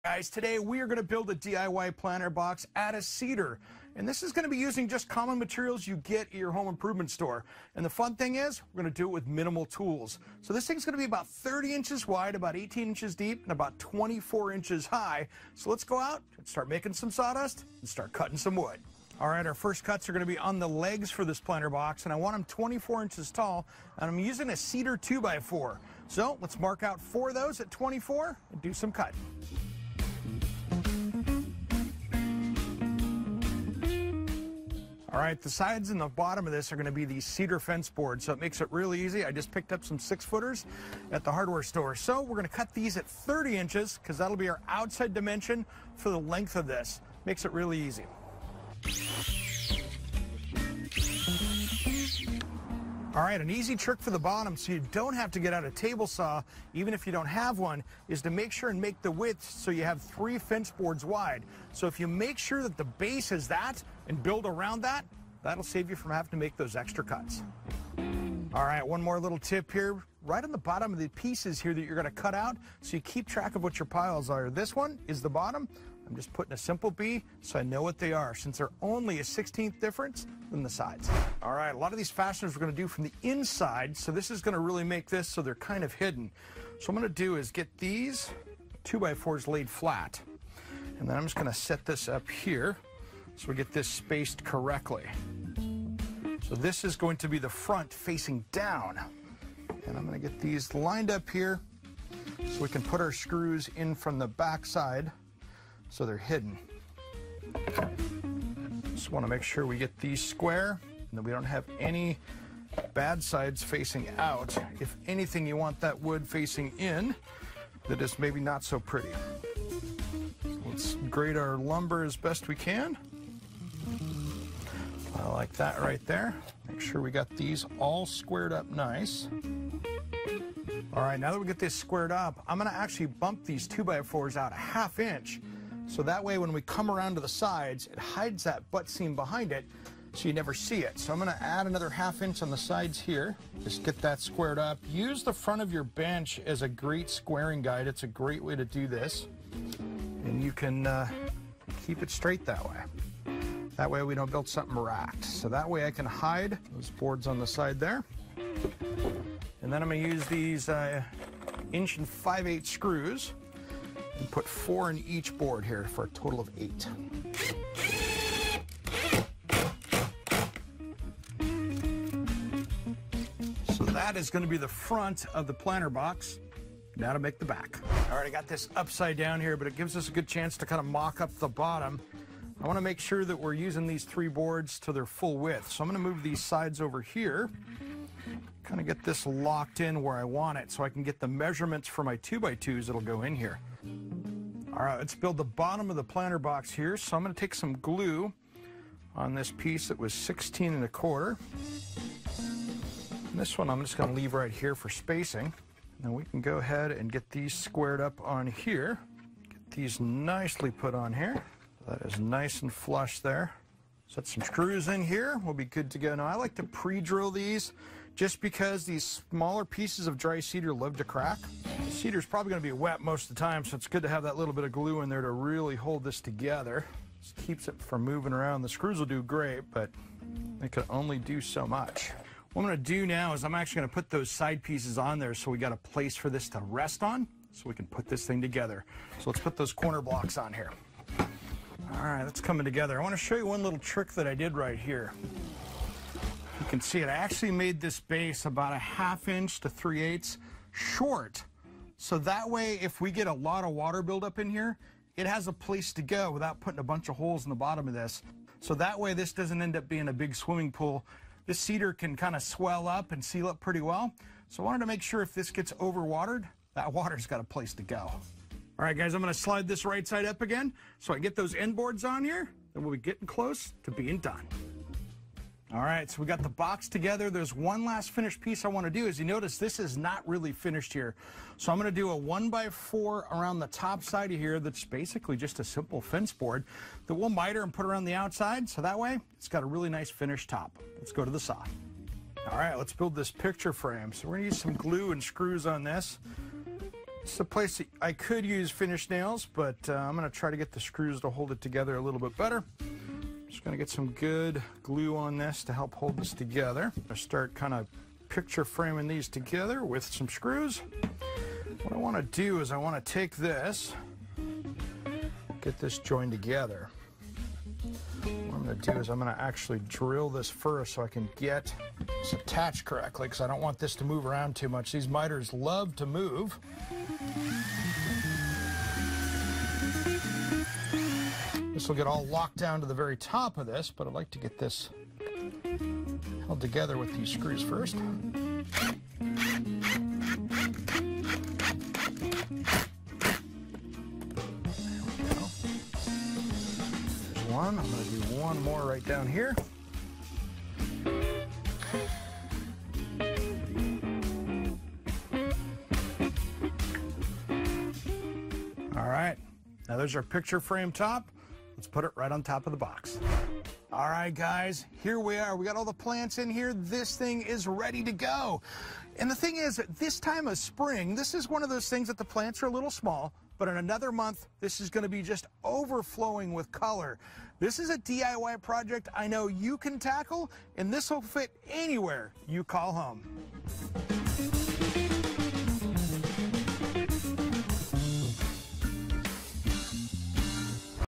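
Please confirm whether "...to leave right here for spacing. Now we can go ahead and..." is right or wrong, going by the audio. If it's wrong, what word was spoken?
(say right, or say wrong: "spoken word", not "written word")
right.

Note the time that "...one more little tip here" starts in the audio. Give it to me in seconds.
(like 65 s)
68 s.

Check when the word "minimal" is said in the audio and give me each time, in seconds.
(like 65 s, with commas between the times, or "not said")
9 s.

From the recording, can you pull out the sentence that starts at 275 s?
All right, so we got the box together.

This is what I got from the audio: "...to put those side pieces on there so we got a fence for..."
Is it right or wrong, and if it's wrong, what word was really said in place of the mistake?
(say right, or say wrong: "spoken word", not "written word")
wrong: "place", not "fence".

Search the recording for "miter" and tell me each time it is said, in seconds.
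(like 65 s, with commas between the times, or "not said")
287 s, 325 s.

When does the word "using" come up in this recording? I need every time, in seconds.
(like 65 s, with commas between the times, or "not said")
4 s, 24 s, 183 s.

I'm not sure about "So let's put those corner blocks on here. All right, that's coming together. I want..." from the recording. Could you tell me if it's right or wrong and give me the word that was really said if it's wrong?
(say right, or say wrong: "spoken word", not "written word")
right.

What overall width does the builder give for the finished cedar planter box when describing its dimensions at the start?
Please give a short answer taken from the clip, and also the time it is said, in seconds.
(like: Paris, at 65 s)
30 inches, at 11 s.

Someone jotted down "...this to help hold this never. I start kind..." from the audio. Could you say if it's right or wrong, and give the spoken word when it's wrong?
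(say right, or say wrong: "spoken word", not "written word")
wrong: "together", not "never".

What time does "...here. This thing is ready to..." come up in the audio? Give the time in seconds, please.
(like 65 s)
366 s.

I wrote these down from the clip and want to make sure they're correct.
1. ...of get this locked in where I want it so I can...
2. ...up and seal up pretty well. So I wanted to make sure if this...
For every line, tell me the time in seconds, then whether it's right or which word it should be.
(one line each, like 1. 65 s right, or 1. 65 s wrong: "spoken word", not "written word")
1. 188 s right
2. 262 s right.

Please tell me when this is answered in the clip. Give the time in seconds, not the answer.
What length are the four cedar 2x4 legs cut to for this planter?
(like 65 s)
22 s.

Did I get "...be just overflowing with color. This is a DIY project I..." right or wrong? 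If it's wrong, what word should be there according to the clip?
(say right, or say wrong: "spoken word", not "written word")
right.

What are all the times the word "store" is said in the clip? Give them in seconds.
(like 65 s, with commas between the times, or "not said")
7 s, 41 s.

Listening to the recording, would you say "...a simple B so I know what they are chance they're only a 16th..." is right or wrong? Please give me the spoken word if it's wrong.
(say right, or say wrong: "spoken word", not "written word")
wrong: "since", not "chance".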